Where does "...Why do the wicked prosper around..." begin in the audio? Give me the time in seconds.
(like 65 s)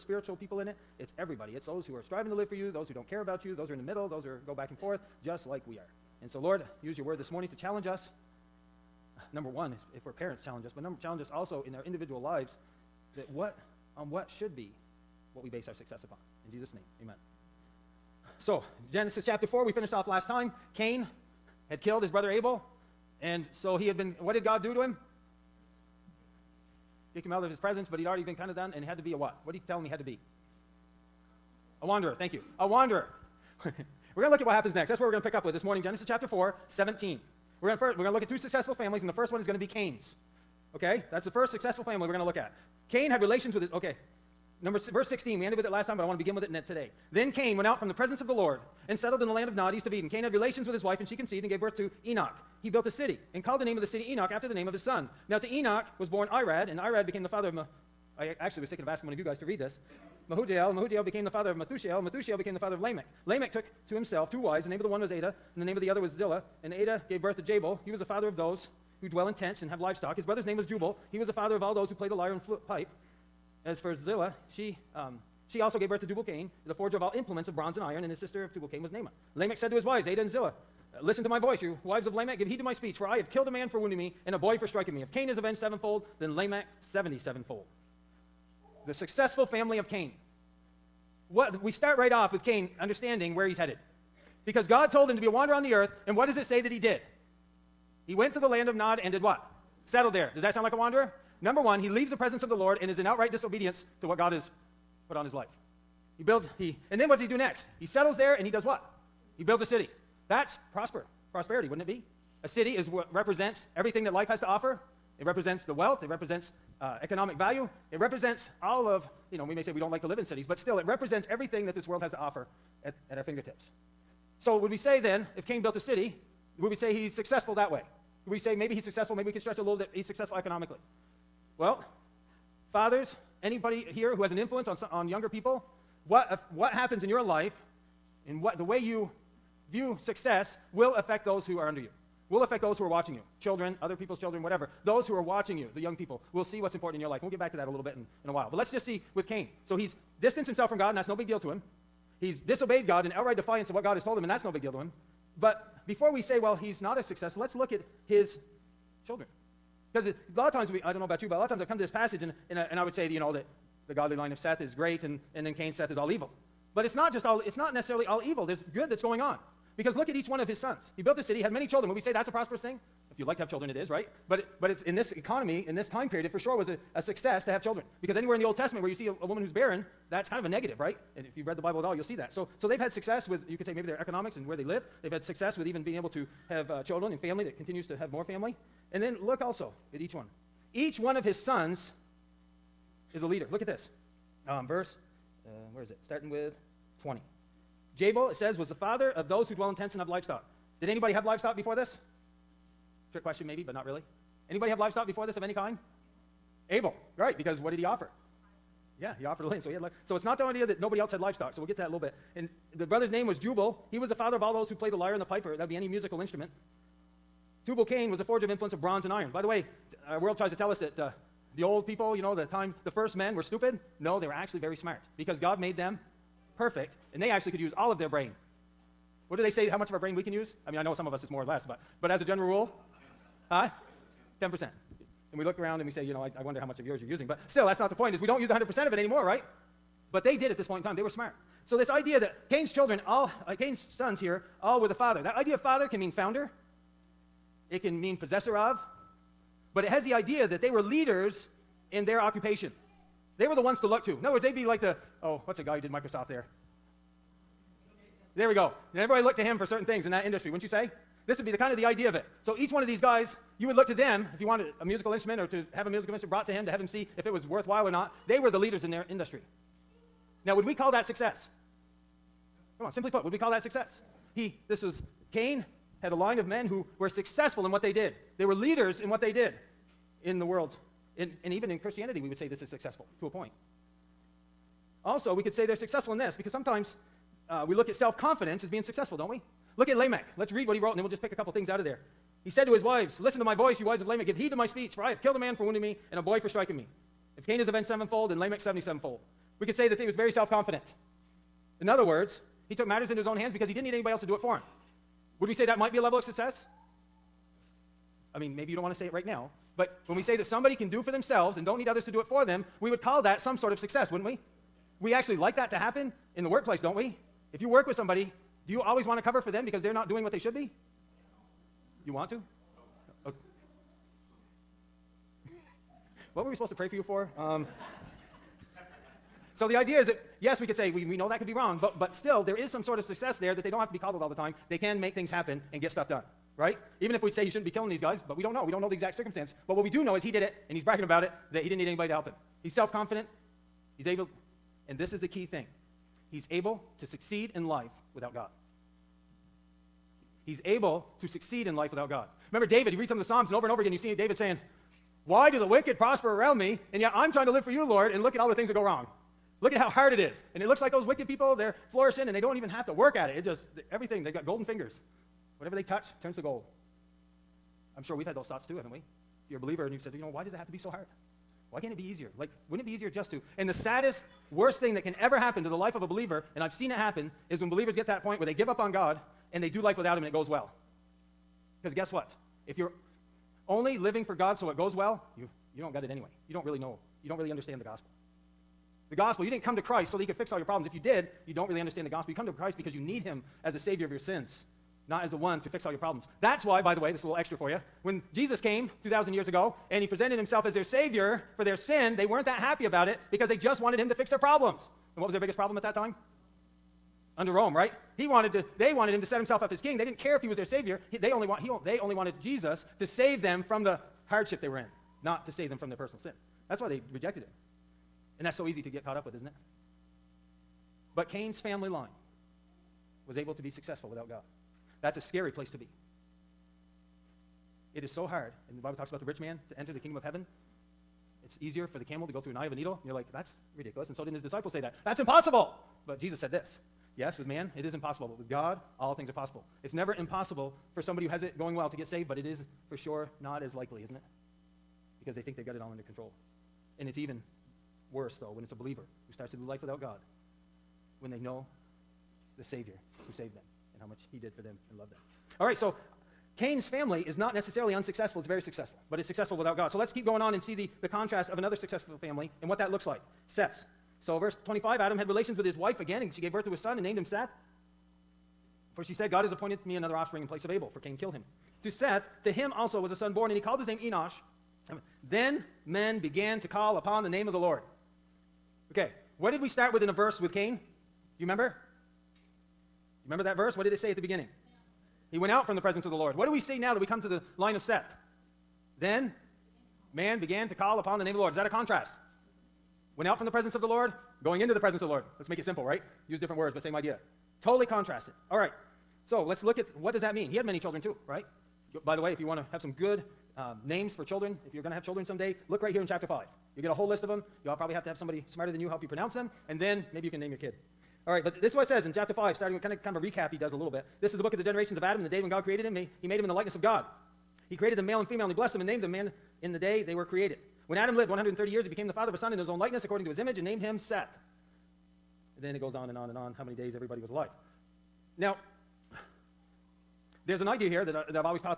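355 s.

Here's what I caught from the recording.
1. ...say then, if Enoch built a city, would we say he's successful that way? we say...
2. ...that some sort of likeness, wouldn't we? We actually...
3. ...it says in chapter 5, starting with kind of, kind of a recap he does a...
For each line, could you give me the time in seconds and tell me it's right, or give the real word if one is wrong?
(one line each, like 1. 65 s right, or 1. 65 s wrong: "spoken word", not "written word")
1. 124 s wrong: "Cain", not "Enoch"
2. 313 s wrong: "success", not "likeness"
3. 511 s right.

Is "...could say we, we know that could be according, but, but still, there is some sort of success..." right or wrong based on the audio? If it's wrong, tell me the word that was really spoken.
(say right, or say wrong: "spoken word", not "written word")
wrong: "wrong", not "according".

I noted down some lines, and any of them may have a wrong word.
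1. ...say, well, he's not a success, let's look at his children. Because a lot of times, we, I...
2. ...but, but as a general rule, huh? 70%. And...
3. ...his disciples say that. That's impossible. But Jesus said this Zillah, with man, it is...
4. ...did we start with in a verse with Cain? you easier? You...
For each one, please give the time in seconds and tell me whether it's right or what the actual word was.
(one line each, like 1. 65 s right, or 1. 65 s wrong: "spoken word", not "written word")
1. 156 s right
2. 231 s wrong: "10", not "70"
3. 434 s wrong: "Yes", not "Zillah"
4. 479 s wrong: "remember", not "easier".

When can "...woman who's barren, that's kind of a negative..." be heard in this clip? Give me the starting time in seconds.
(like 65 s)
179 s.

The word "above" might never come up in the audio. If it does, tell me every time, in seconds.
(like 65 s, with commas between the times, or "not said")
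not said.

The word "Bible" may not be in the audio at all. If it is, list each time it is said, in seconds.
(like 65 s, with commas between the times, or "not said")
181 s, 428 s.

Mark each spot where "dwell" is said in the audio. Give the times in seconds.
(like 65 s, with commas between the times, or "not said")
69 s, 199 s.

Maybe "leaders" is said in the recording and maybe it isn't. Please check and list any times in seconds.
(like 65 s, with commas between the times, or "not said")
193 s, 250 s, 268 s, 278 s.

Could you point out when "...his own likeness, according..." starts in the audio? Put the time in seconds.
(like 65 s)
522 s.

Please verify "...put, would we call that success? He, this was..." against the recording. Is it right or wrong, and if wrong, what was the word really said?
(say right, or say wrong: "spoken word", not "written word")
right.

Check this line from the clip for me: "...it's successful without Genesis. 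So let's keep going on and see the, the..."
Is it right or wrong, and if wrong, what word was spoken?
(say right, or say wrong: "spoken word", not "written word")
wrong: "God", not "Genesis".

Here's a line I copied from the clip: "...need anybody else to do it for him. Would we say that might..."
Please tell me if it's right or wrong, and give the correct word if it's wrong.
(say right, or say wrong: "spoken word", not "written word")
right.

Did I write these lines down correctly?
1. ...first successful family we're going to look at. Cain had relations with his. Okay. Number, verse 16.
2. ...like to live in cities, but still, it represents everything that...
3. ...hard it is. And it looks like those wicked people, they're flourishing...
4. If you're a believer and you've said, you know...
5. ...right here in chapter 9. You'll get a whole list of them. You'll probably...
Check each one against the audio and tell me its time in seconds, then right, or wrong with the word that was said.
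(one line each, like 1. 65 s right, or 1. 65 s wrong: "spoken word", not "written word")
1. 41 s right
2. 119 s right
3. 359 s right
4. 368 s right
5. 505 s wrong: "5", not "9".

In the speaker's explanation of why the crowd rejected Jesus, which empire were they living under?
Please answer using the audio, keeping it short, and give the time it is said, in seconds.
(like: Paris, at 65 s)
Rome, at 407 s.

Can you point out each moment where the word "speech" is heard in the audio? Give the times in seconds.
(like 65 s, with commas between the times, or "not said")
82 s, 294 s.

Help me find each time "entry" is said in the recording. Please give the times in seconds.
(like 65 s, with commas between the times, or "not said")
not said.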